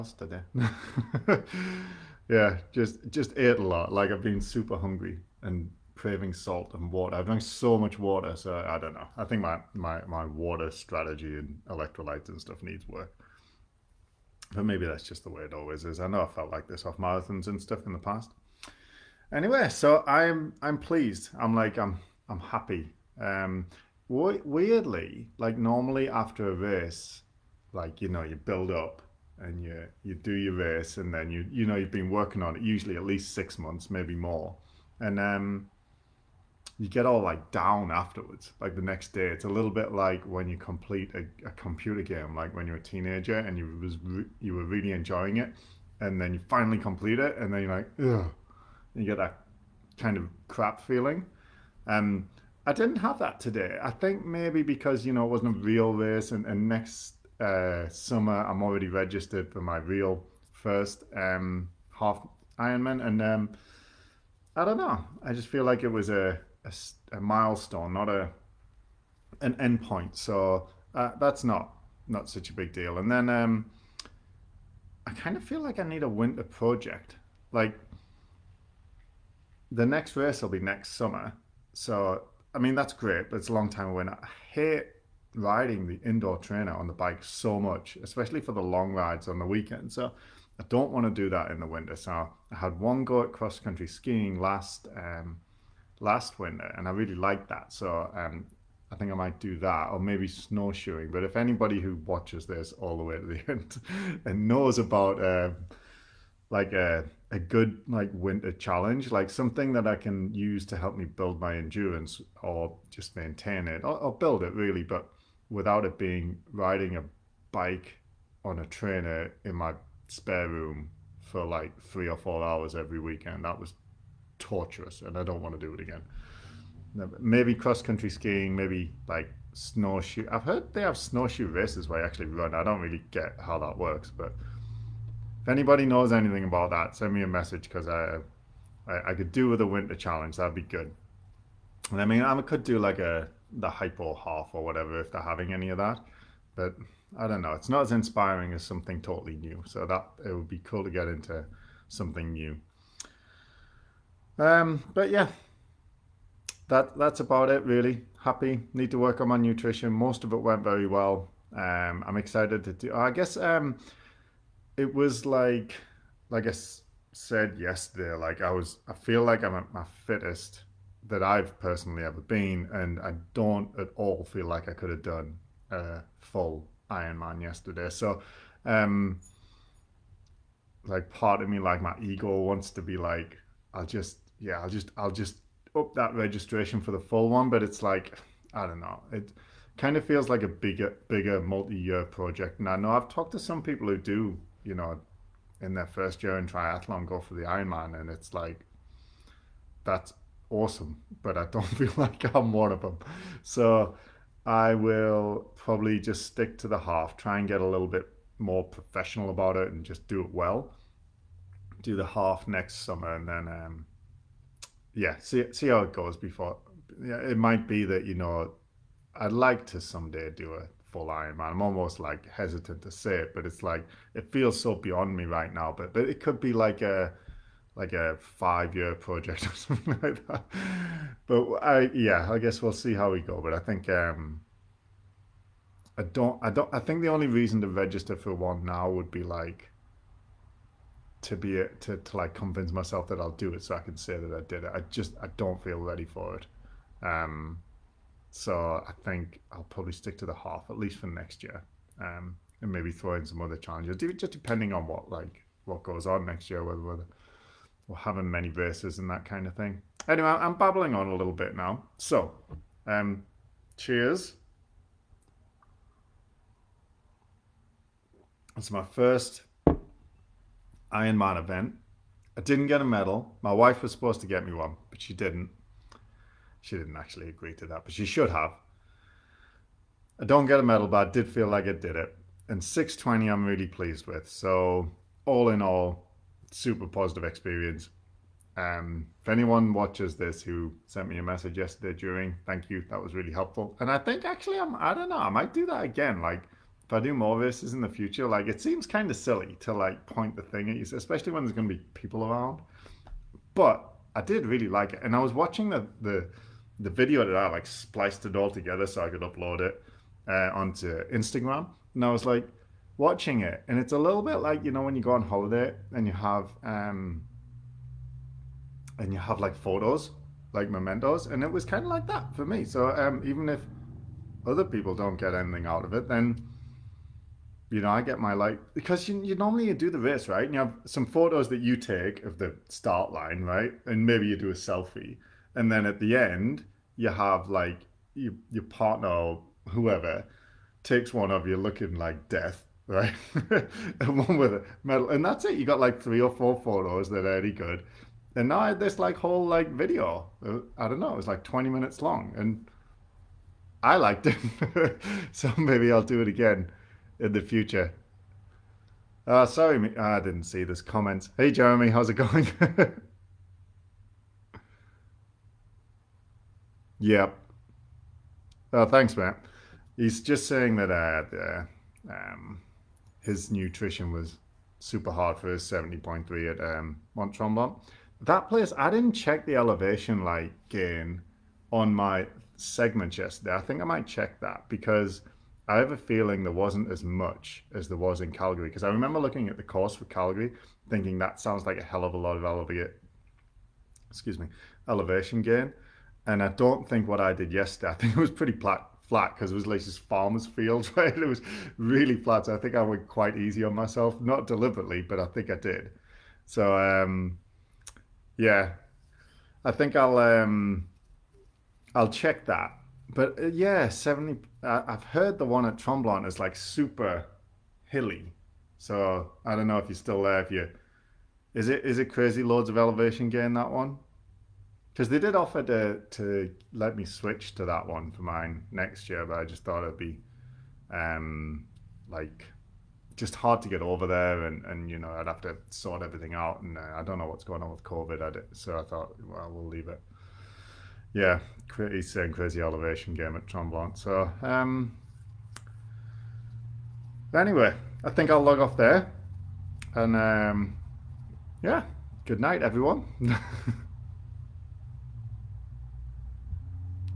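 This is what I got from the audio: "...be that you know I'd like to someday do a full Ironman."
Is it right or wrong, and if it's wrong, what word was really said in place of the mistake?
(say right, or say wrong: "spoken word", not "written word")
right.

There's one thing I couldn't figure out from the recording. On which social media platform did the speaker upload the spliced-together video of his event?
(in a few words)
Instagram.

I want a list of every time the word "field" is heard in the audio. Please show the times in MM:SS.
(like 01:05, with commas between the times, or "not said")
06:40.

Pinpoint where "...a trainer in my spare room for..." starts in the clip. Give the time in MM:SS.
01:58.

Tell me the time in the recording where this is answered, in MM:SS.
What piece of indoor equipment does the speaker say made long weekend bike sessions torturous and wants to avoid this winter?
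01:26.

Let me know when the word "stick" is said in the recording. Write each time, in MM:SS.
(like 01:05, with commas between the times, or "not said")
03:26, 04:09.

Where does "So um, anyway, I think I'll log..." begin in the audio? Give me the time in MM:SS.
07:23.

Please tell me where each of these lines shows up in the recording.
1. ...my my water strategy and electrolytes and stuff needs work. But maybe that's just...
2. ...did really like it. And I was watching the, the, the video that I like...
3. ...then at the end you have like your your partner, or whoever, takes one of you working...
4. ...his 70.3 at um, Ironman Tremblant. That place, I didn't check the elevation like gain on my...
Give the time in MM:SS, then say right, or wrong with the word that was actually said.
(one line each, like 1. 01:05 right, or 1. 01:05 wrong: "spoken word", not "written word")
1. 00:09 right
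2. 05:04 right
3. 05:35 wrong: "looking", not "working"
4. 06:15 wrong: "Mont", not "Ironman".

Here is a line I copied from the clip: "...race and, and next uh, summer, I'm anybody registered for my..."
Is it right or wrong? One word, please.
wrong.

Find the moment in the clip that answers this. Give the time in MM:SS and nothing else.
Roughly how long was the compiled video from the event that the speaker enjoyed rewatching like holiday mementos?
05:51.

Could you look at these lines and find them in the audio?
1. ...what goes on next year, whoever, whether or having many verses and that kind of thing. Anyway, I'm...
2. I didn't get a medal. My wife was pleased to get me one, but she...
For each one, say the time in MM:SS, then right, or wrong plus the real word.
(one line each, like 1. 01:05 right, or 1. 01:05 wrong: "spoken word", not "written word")
1. 04:15 wrong: "whether", not "whoever"
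2. 04:32 wrong: "supposed", not "pleased".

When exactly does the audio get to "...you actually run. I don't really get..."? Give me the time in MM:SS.
02:11.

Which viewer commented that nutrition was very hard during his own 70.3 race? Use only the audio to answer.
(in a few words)
Matt.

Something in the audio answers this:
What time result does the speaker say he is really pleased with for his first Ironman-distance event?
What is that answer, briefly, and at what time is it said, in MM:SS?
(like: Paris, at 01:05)
6:20, at 04:42.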